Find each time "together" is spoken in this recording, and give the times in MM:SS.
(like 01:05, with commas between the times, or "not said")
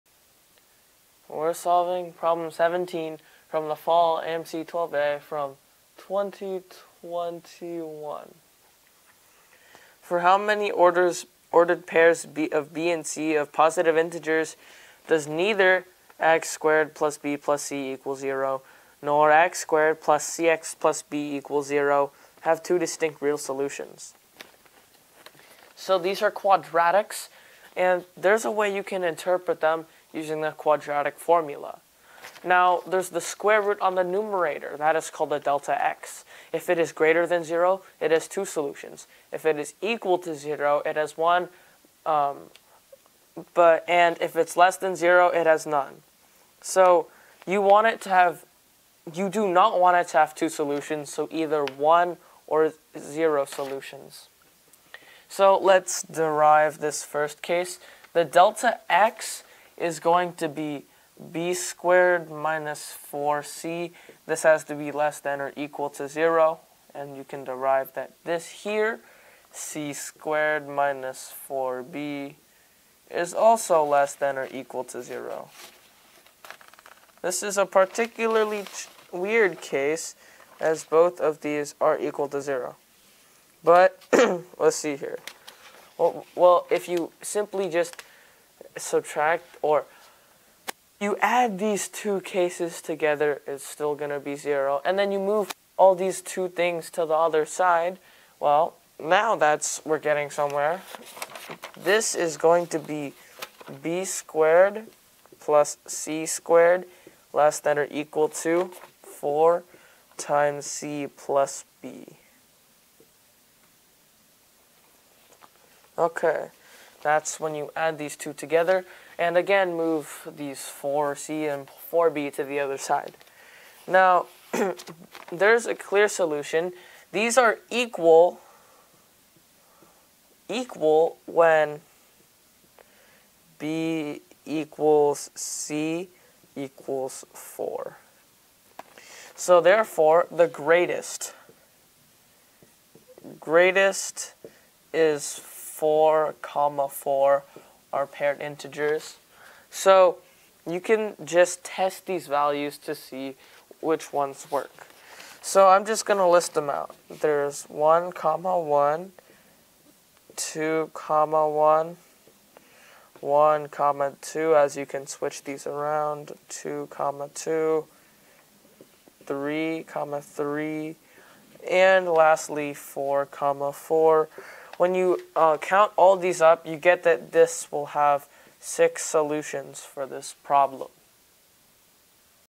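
01:32, 01:58.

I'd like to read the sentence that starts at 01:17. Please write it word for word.
This is a particularly weird case as both of these are equal to 0.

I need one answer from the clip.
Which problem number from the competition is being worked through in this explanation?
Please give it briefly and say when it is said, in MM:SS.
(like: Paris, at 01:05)
17, at 00:02.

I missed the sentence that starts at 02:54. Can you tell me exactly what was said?
When you uh, count all these up, you get that this will have six solutions for this problem.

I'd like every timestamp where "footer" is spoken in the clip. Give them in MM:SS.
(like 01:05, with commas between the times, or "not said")
not said.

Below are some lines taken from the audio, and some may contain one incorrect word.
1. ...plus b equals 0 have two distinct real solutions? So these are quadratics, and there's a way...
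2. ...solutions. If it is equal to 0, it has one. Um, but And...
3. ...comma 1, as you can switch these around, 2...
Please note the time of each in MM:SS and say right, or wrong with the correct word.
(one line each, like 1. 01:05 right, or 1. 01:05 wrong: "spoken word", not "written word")
1. 00:20 right
2. 00:38 right
3. 02:43 wrong: "2", not "1".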